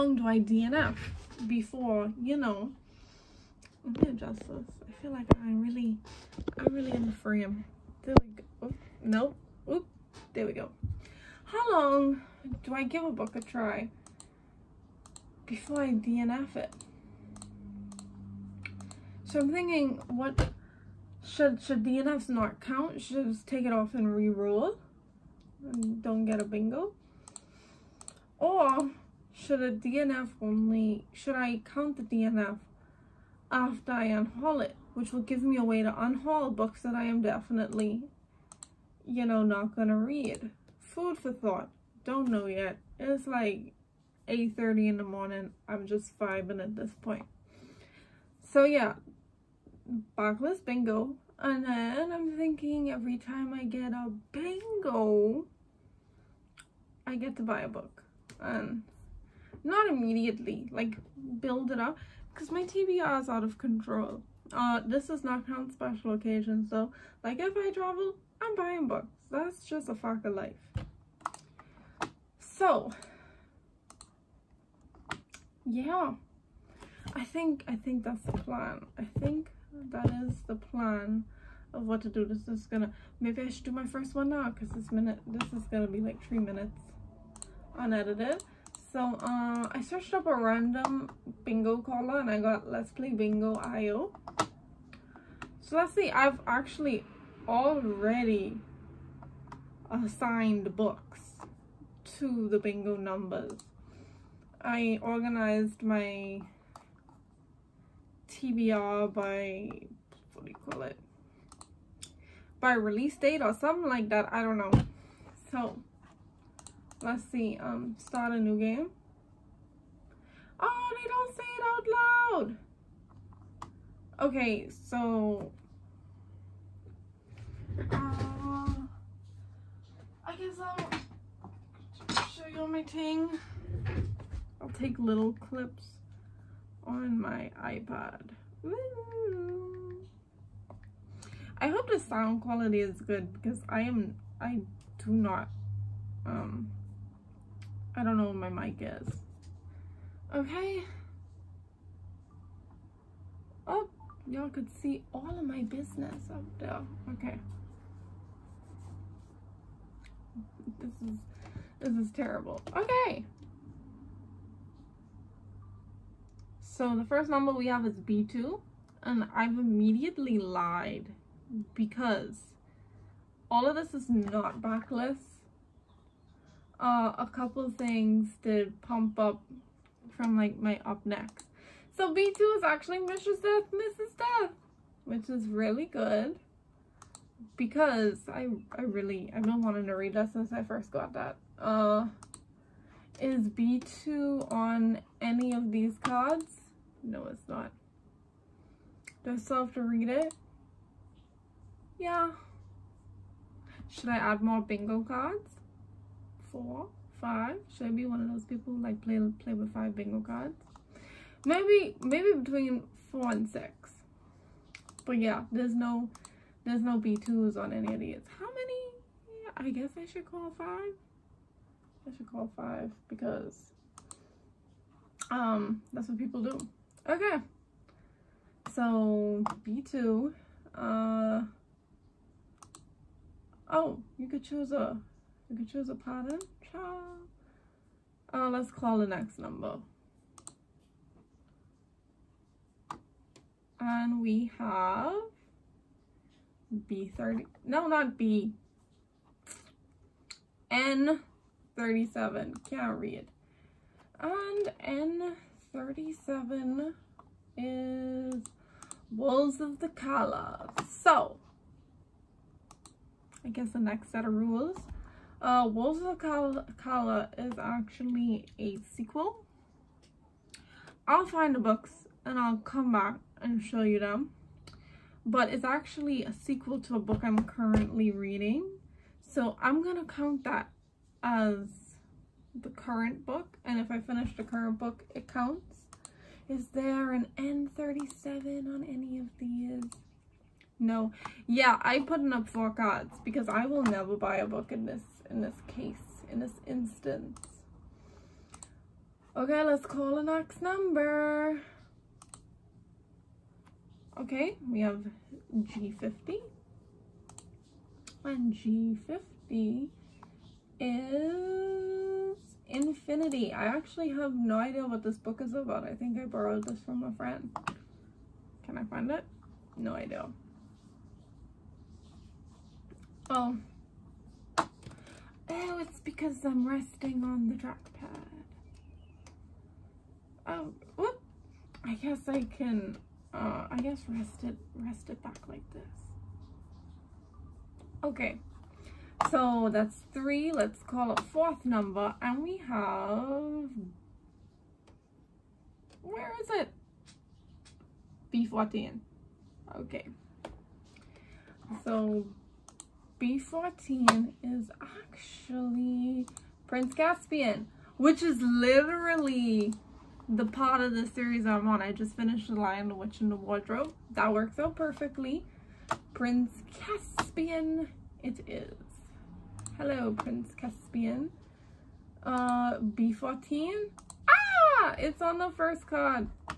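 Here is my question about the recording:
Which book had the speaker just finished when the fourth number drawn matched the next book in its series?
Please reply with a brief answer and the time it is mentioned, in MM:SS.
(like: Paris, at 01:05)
The Lion, the Witch, and the Wardrobe, at 06:02.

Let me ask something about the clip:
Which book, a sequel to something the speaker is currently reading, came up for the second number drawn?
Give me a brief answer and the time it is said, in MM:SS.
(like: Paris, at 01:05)
Wolves of the Calla, at 04:19.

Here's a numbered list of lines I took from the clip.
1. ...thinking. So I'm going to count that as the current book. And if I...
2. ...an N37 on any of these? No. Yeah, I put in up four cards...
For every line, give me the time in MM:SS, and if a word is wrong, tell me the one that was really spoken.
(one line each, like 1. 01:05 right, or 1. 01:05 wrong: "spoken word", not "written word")
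1. 04:38 wrong: "reading", not "thinking"
2. 04:47 right.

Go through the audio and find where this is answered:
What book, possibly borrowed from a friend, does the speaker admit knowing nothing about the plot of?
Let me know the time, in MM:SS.
05:12.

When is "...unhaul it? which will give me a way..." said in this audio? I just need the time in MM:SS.
00:34.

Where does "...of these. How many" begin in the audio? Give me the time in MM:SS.
03:37.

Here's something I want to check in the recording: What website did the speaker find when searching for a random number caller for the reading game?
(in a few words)
Let's Play Bingo IO.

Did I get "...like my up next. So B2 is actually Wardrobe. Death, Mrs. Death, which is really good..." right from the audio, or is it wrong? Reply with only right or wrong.
wrong.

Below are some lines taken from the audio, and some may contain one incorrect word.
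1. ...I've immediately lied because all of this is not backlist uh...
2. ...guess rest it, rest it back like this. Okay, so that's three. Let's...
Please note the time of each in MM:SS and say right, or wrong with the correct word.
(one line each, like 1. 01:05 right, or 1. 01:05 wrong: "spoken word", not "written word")
1. 02:49 right
2. 05:33 right.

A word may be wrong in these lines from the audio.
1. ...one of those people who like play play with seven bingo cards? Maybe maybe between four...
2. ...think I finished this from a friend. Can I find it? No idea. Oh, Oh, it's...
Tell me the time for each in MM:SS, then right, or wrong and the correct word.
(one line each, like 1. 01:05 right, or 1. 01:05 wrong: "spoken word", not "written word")
1. 03:28 wrong: "five", not "seven"
2. 05:15 wrong: "borrowed", not "finished".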